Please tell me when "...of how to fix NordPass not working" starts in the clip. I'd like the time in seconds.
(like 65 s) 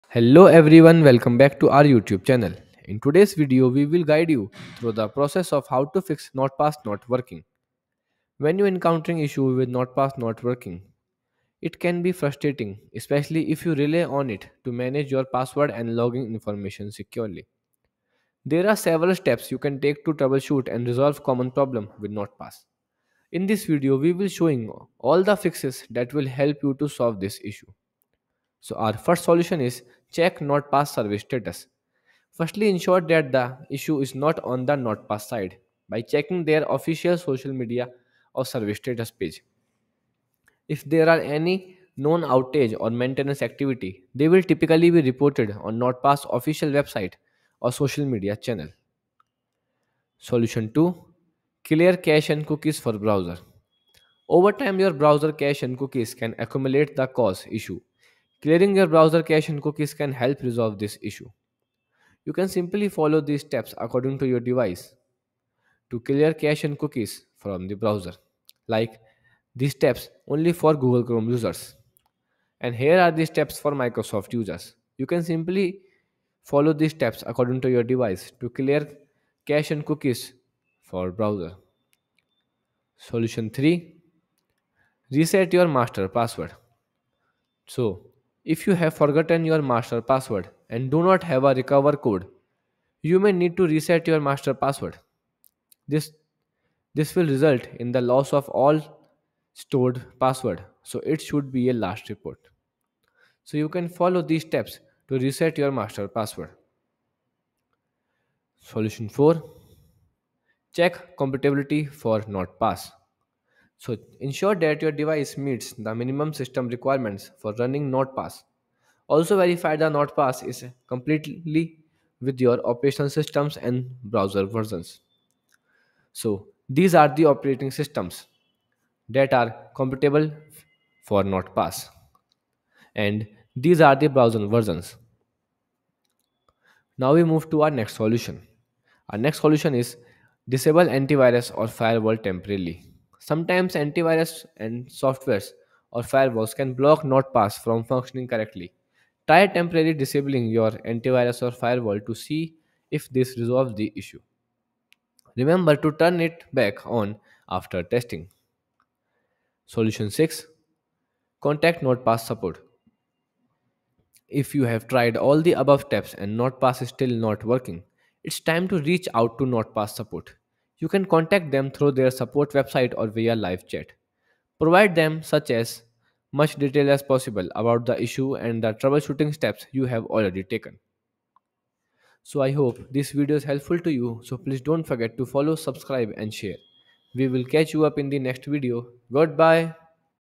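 5 s.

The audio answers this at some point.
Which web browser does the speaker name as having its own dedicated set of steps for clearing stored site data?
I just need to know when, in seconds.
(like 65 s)
70 s.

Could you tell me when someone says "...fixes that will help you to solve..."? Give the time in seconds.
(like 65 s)
25 s.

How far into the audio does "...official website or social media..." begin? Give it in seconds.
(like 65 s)
46 s.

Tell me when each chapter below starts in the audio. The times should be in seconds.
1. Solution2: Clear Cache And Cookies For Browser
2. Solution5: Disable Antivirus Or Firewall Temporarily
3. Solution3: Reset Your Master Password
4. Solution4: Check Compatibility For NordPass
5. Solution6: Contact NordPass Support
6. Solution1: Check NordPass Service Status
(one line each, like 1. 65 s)
1. 50 s
2. 139 s
3. 83 s
4. 109 s
5. 159 s
6. 28 s.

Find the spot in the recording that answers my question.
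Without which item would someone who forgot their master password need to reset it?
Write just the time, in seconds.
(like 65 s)
91 s.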